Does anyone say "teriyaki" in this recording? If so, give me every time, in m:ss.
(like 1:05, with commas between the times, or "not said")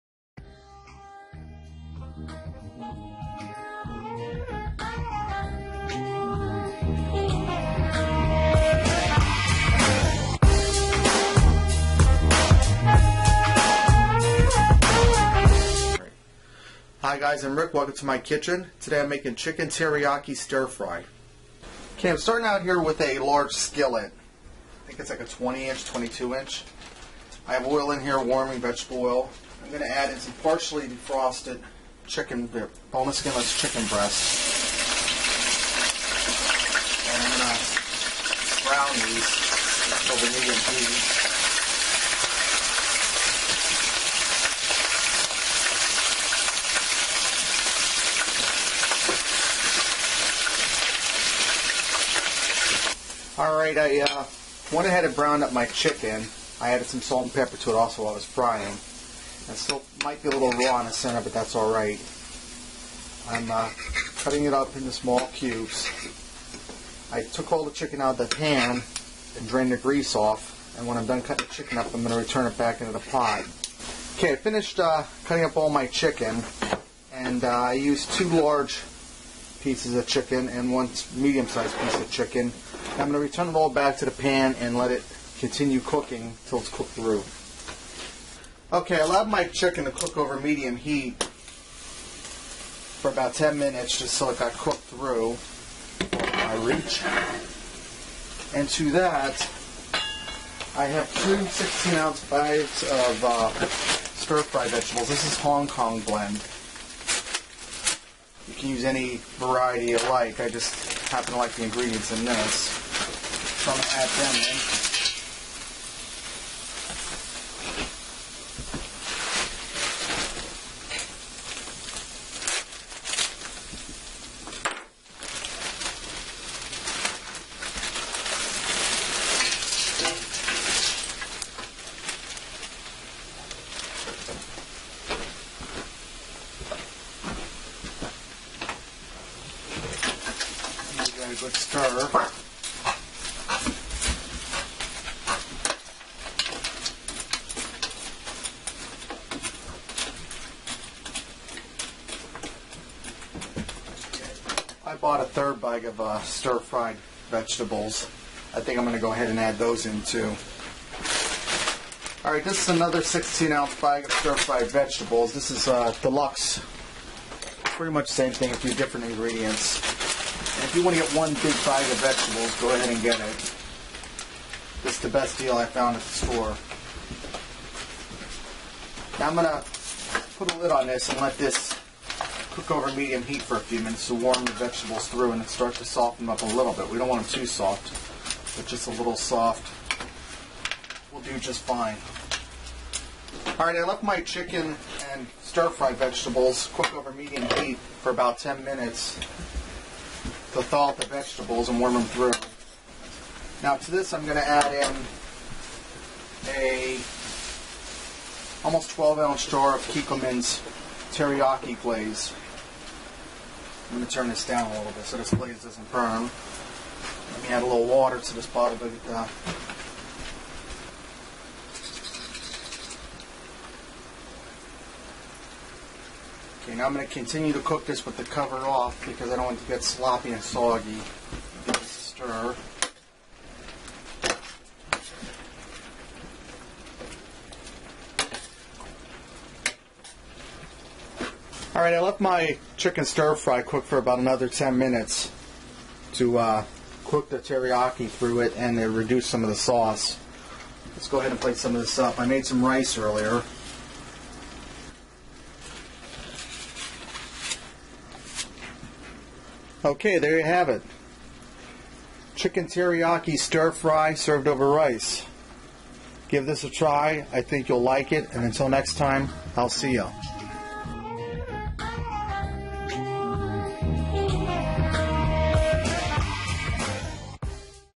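0:19, 3:31, 4:07, 4:22.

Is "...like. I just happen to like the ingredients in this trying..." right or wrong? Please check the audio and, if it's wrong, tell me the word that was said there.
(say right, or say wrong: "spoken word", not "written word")
right.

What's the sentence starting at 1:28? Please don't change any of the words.
Okay, I allowed my chicken to cook over medium heat for about 10 minutes just so it got cooked through my reach.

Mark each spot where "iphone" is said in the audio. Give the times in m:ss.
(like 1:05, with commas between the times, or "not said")
not said.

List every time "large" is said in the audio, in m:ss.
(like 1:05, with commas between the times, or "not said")
0:23, 1:18.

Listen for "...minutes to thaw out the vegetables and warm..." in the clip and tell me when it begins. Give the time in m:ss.
3:18.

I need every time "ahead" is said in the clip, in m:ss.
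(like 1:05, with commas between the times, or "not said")
0:54, 2:39, 2:52, 4:11.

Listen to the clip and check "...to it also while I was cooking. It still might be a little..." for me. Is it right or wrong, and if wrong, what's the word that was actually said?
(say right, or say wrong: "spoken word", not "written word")
wrong: "frying", not "cooking".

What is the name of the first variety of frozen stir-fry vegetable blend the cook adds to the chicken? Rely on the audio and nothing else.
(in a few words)
Hong Kong blend.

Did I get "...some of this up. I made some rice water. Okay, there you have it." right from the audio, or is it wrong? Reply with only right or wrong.
wrong.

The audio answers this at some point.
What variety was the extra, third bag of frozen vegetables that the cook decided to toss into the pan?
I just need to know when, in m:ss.
2:46.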